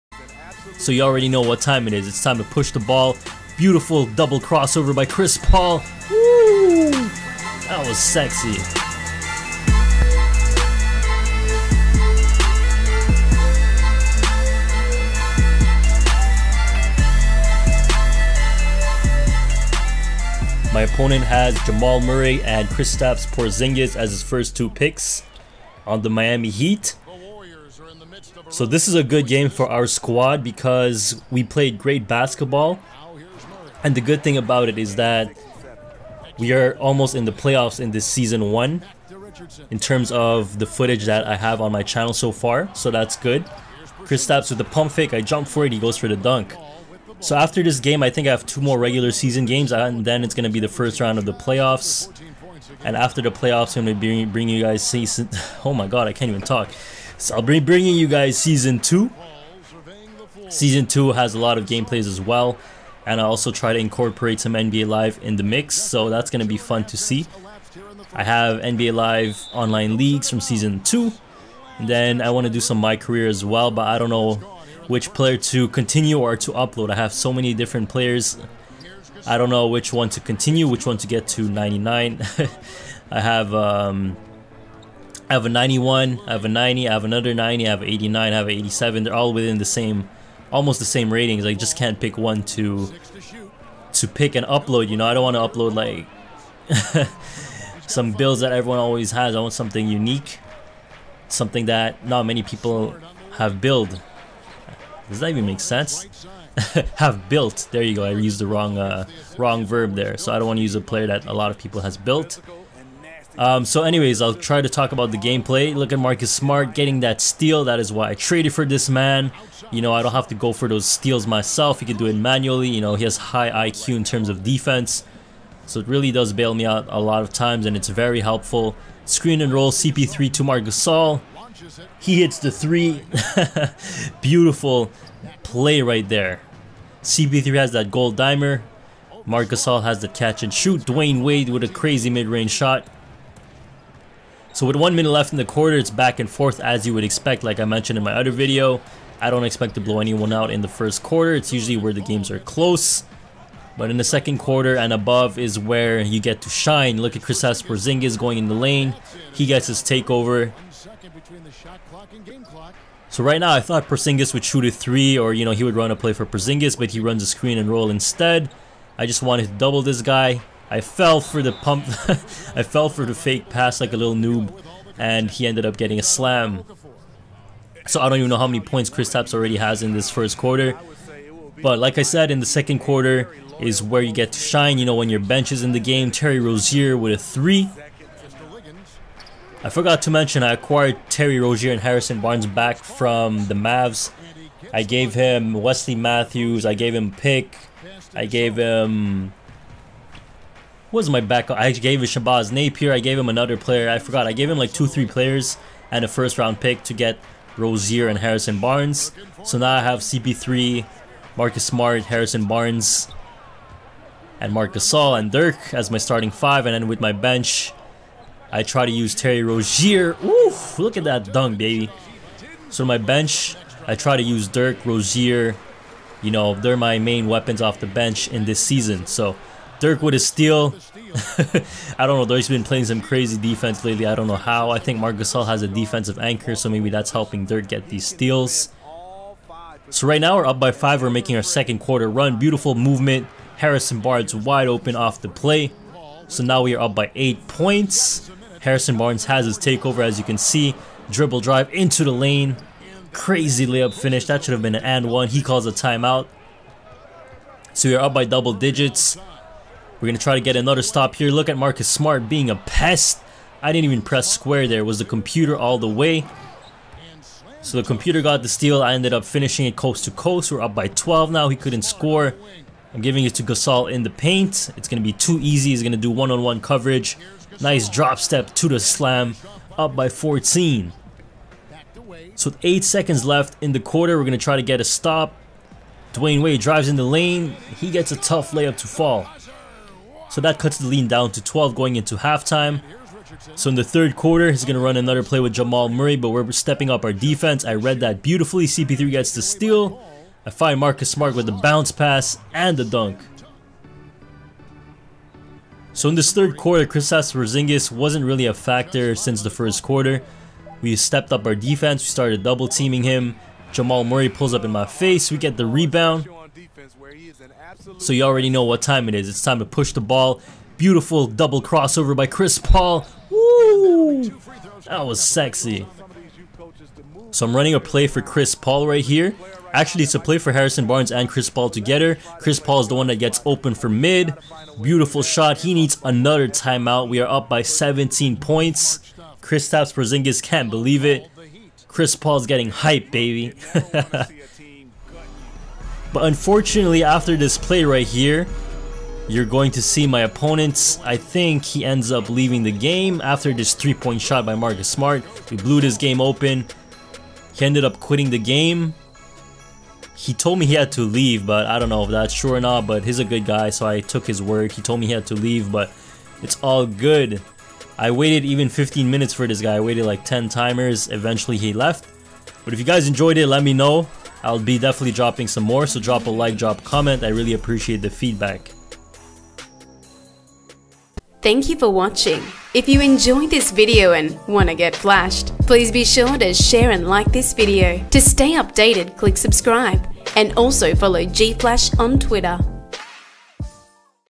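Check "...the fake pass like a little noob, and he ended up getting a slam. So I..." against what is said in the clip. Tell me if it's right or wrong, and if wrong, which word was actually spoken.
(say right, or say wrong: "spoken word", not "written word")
right.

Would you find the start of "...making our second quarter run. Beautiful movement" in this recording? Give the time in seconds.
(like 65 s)
241 s.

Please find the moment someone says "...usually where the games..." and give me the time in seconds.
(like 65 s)
151 s.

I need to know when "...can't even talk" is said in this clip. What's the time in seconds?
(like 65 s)
56 s.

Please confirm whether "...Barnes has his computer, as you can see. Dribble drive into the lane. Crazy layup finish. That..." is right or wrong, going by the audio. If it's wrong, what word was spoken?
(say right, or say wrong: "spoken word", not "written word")
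wrong: "takeover", not "computer".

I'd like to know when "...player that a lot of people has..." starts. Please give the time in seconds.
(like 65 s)
110 s.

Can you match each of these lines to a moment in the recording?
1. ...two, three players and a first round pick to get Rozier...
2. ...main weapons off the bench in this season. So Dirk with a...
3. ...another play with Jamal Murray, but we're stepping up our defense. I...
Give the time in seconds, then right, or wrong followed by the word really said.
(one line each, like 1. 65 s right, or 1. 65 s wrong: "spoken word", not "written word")
1. 204 s right
2. 226 s right
3. 294 s right.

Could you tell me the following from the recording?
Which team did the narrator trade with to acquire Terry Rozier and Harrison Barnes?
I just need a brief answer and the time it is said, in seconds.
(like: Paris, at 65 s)
Mavs, at 193 s.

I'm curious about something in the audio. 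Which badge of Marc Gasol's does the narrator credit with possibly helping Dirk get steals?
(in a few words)
Defensive anchor.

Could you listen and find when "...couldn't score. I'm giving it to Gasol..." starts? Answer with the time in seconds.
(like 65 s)
271 s.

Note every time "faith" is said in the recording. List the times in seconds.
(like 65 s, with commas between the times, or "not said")
not said.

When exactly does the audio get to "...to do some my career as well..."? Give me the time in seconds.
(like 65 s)
72 s.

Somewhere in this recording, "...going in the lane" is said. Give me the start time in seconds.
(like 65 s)
158 s.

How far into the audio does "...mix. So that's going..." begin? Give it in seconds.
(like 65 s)
65 s.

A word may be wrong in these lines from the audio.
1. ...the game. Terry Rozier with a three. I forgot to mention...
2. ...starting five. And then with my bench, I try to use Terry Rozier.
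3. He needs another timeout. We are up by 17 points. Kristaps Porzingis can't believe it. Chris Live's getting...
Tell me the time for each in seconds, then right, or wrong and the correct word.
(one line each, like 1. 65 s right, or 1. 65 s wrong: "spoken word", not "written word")
1. 185 s right
2. 215 s right
3. 335 s wrong: "Paul", not "Live".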